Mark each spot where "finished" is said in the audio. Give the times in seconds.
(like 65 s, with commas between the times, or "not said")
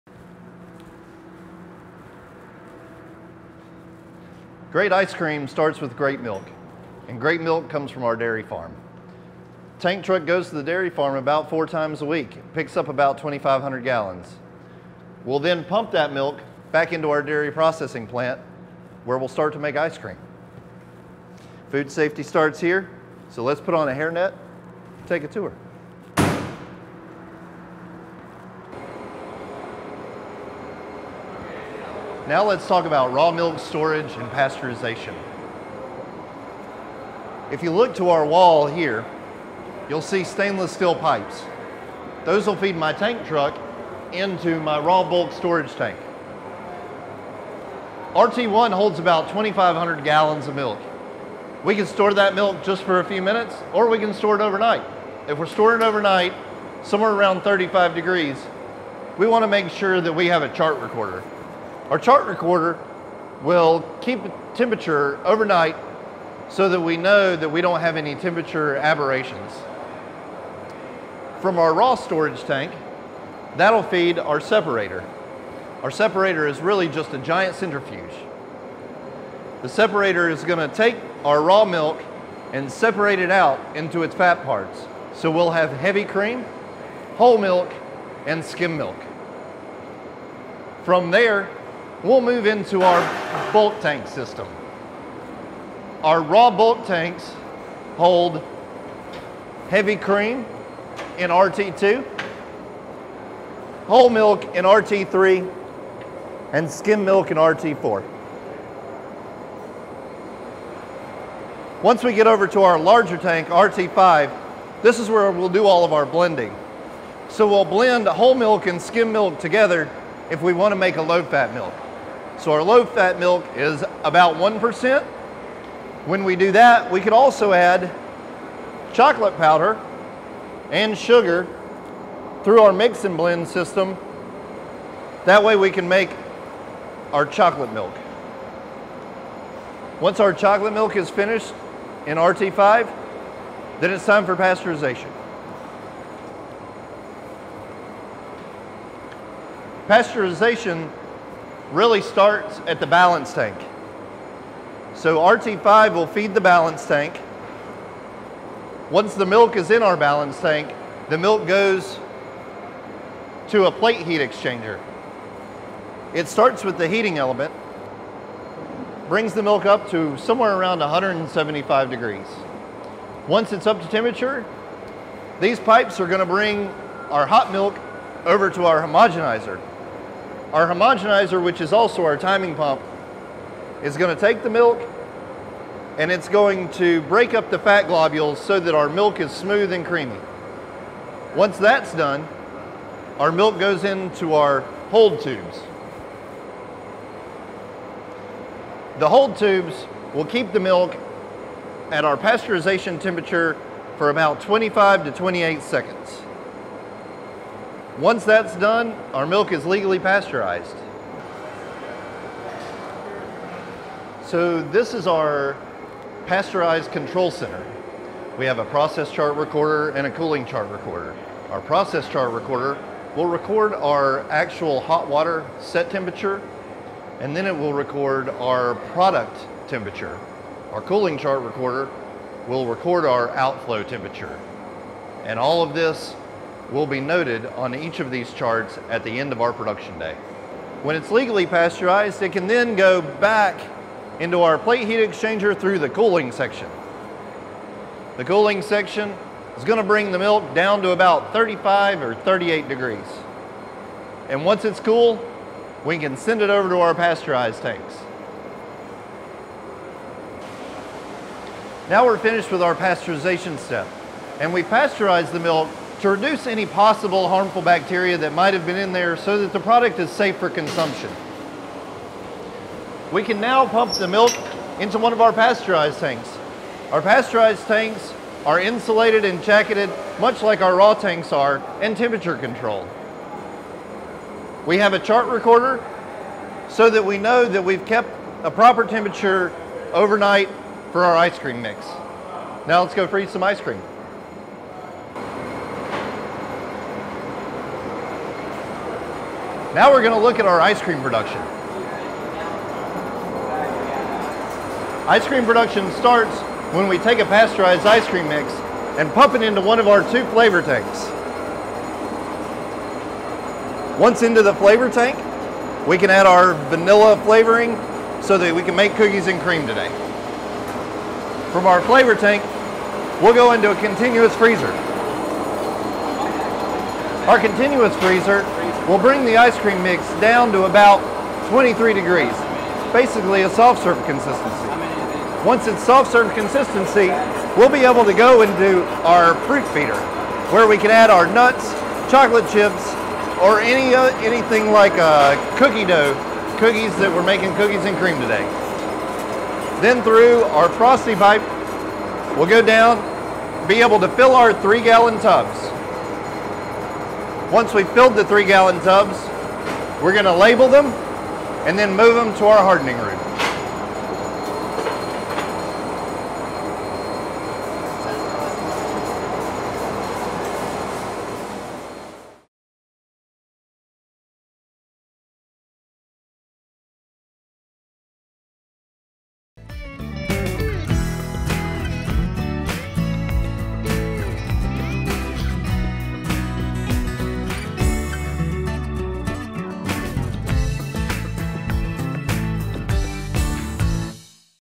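141 s, 262 s.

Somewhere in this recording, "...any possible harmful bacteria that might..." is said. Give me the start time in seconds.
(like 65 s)
266 s.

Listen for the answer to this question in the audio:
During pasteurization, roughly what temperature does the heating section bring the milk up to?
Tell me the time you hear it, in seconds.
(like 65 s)
170 s.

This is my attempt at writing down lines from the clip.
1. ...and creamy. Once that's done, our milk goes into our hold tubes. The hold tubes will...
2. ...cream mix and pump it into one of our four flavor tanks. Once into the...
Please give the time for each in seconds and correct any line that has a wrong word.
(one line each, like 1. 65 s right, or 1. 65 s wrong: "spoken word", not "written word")
1. 189 s right
2. 308 s wrong: "two", not "four".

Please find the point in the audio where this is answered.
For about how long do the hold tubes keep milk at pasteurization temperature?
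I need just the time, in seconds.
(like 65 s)
204 s.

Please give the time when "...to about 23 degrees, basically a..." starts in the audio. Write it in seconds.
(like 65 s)
330 s.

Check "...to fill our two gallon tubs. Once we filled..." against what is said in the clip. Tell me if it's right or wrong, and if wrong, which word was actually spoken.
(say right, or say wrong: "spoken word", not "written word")
wrong: "three", not "two".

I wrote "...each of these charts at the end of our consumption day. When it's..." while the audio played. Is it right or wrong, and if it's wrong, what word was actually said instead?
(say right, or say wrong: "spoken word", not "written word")
wrong: "production", not "consumption".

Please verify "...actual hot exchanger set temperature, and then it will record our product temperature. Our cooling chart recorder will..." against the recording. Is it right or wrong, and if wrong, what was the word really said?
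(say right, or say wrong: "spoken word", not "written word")
wrong: "water", not "exchanger".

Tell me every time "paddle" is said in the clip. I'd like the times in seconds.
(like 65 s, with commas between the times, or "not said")
not said.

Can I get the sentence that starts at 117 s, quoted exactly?
So we'll blend whole milk and skim milk together if we want to make a low-fat milk.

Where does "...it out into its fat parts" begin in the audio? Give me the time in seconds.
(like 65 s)
83 s.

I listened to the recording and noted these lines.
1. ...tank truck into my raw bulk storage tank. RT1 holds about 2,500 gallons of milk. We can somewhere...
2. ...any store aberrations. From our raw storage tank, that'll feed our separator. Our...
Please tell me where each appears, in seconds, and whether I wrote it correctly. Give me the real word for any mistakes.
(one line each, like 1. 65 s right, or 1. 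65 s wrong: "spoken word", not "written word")
1. 42 s wrong: "store", not "somewhere"
2. 67 s wrong: "temperature", not "store".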